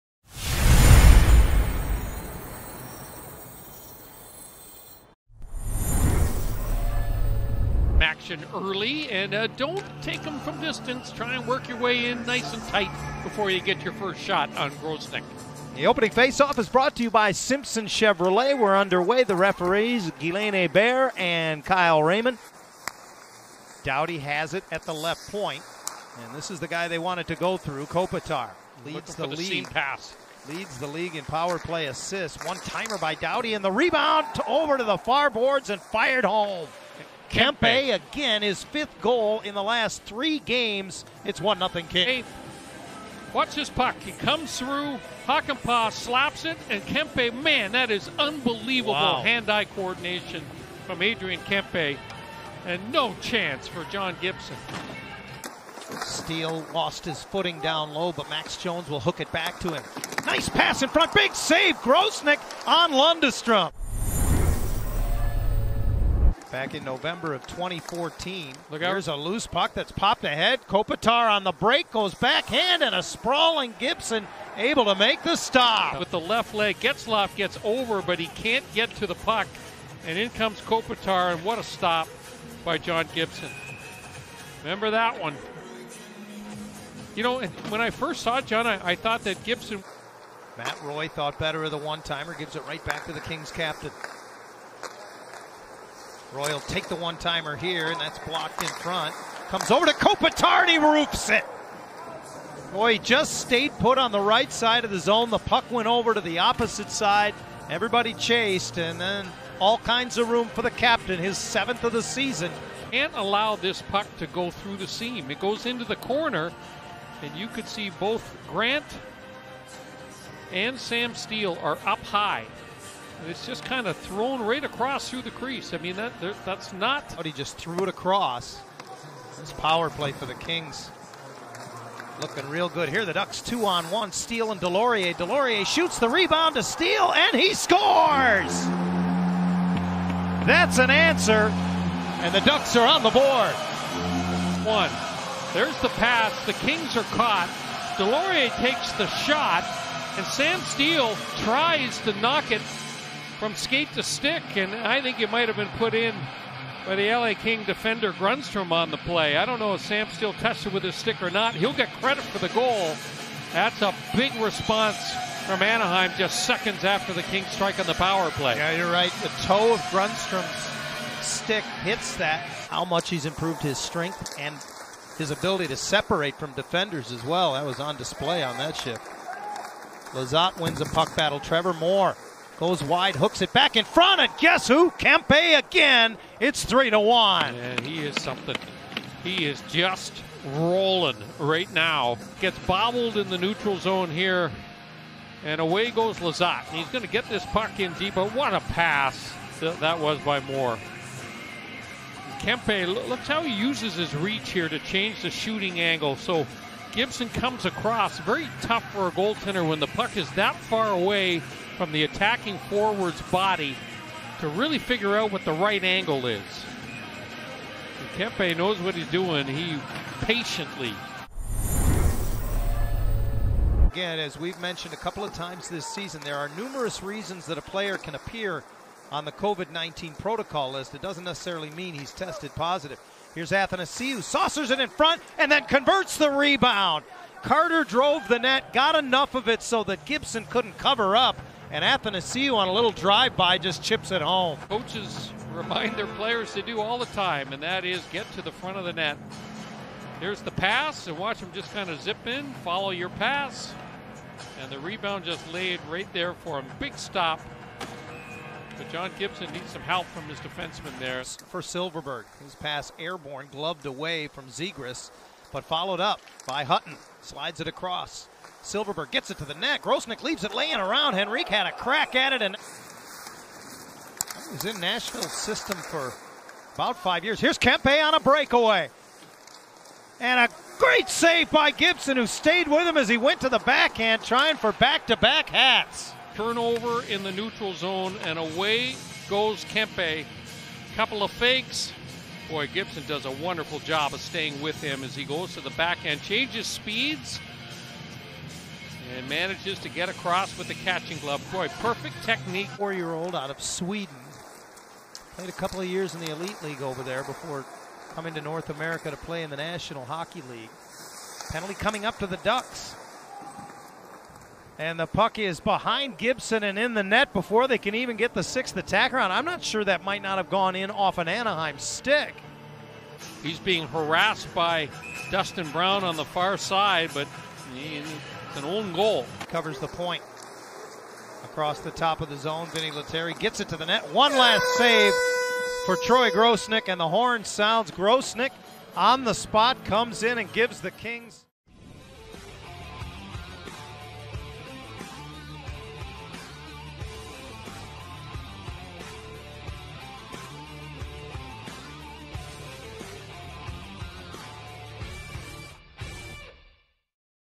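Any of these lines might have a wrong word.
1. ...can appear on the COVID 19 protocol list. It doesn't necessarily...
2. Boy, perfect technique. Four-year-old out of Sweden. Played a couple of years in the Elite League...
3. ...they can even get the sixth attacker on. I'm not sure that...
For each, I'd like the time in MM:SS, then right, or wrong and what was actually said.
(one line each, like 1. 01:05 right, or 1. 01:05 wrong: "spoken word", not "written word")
1. 03:47 right
2. 05:01 right
3. 05:17 right.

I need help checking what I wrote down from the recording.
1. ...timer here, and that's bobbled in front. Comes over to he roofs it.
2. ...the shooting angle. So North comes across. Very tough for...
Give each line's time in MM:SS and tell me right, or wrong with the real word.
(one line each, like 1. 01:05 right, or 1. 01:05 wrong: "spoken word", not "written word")
1. 01:37 wrong: "blocked", not "bobbled"
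2. 03:25 wrong: "Gibson", not "North".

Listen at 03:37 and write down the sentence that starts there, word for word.
And Kempe knows what he's doing.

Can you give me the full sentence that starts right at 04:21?
For Silfverberg, his pass airborne, gloved away from Zegras, but followed up by Hutton.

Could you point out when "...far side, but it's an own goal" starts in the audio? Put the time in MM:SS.
05:26.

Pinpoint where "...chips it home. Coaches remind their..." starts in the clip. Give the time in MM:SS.
04:03.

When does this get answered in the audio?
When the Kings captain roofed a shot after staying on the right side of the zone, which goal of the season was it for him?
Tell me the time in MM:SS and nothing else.
01:51.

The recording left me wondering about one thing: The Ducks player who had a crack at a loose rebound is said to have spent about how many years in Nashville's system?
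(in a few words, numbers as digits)
5.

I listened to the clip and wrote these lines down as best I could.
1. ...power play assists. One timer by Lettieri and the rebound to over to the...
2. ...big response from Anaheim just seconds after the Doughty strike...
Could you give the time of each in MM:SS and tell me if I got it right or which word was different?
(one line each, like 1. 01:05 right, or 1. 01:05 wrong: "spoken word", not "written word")
1. 00:31 wrong: "Doughty", not "Lettieri"
2. 02:44 wrong: "Kings", not "Doughty".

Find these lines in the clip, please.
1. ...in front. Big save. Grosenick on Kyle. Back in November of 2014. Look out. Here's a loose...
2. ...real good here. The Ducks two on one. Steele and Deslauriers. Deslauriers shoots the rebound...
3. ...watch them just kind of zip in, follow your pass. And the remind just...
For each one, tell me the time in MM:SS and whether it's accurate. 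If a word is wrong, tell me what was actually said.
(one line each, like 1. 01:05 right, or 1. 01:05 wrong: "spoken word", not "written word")
1. 01:00 wrong: "Lundestrom", not "Kyle"
2. 02:12 right
3. 04:11 wrong: "rebound", not "remind".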